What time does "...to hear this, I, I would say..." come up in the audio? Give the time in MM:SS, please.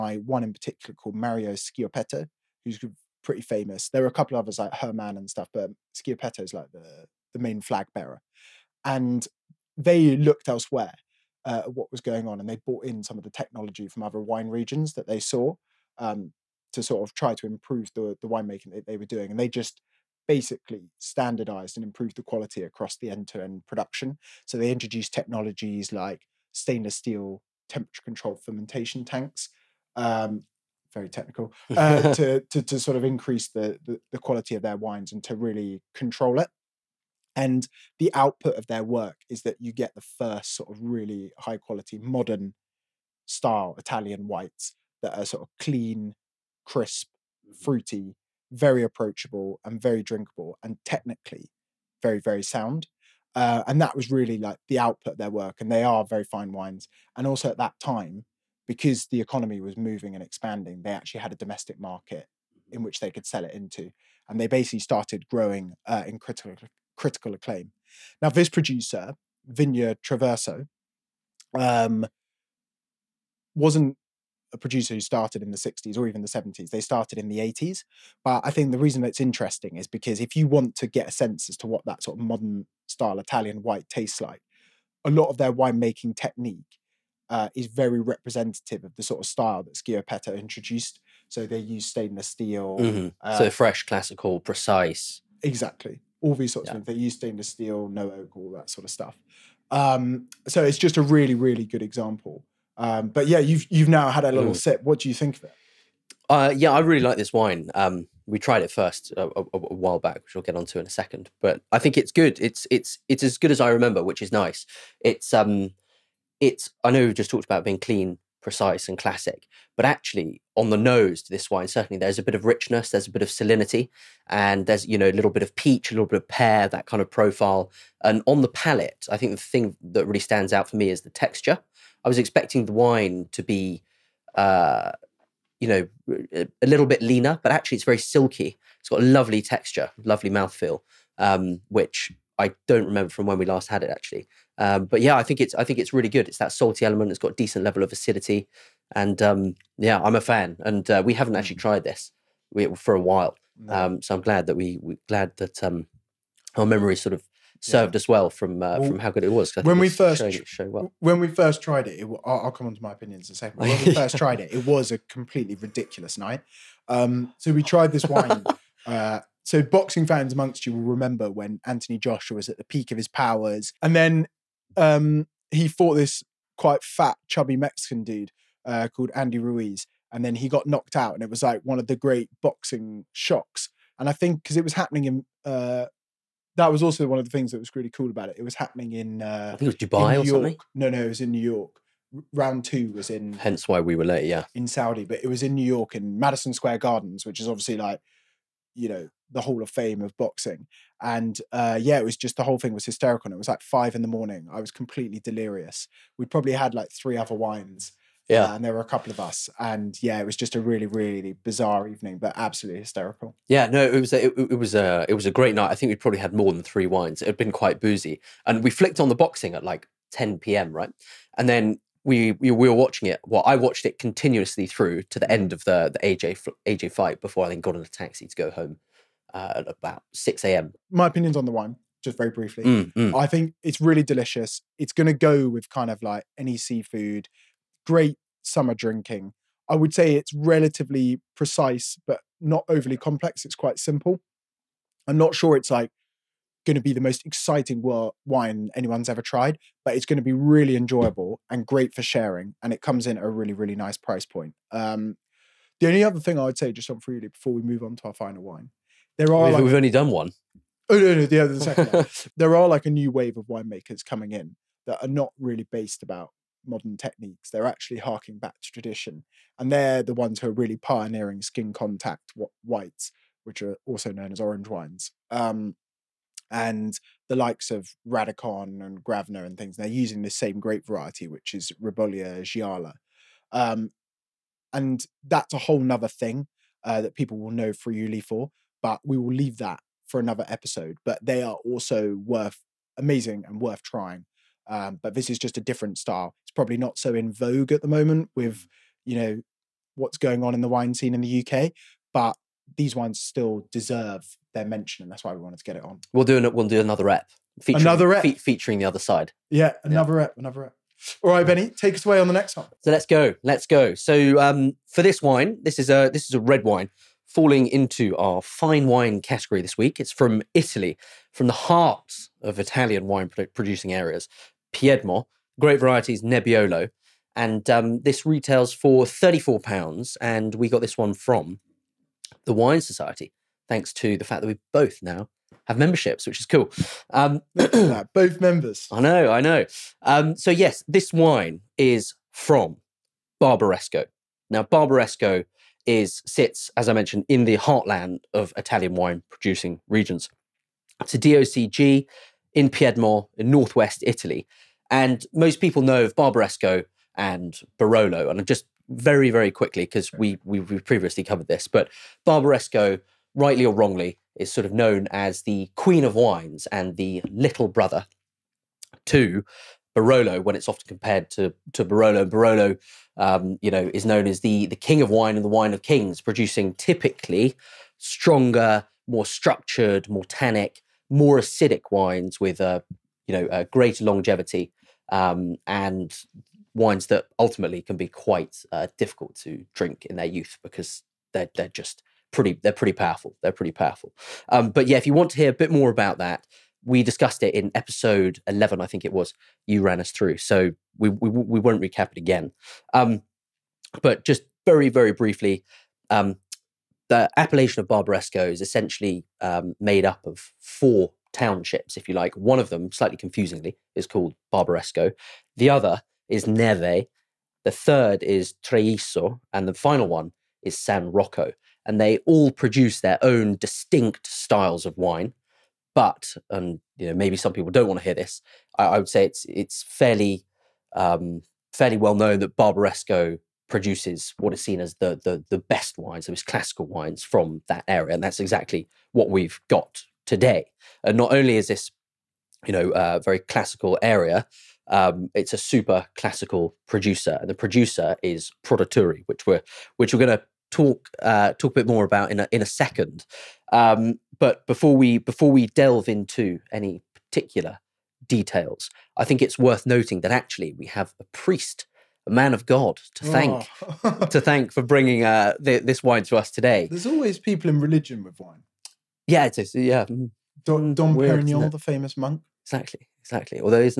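07:08.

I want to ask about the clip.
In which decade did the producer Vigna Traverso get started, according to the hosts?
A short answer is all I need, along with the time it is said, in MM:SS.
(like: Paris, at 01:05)
1980s, at 01:17.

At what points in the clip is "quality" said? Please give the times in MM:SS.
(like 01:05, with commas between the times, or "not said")
00:22, 00:34, 00:41.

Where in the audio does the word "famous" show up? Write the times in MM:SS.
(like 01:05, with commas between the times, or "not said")
00:03, 07:51.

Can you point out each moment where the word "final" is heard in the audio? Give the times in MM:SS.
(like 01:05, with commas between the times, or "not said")
04:18, 06:59.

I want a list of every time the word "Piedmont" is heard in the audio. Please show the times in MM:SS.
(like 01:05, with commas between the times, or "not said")
05:24, 05:52.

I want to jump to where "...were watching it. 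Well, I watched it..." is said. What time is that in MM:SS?
03:42.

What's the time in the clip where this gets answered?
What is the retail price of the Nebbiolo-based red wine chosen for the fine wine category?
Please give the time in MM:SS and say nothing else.
05:29.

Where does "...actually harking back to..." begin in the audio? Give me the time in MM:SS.
04:27.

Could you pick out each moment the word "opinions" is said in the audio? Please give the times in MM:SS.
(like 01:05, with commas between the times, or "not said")
02:42, 03:51.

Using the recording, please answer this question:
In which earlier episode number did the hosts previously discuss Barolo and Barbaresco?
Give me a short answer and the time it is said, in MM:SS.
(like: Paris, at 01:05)
11, at 06:37.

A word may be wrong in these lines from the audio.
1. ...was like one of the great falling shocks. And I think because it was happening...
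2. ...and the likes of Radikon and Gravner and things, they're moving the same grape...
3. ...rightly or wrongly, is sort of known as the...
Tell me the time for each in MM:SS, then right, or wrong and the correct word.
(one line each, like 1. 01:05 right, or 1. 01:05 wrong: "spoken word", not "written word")
1. 03:01 wrong: "boxing", not "falling"
2. 04:36 wrong: "using", not "moving"
3. 06:03 right.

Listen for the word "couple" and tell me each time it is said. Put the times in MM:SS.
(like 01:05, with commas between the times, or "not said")
00:04, 03:28.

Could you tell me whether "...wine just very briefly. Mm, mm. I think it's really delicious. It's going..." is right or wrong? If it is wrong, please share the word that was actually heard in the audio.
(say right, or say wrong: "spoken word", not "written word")
right.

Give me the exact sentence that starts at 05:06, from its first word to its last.
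We'll do an, we'll do another rep, featuring, another rep, fe- featuring the other side.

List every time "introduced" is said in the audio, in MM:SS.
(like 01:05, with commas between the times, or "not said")
00:24, 01:30.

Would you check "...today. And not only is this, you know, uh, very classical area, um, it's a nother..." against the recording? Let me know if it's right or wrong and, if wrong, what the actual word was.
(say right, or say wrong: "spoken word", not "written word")
wrong: "super", not "nother".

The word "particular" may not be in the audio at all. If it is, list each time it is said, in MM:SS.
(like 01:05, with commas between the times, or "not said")
00:00, 07:37.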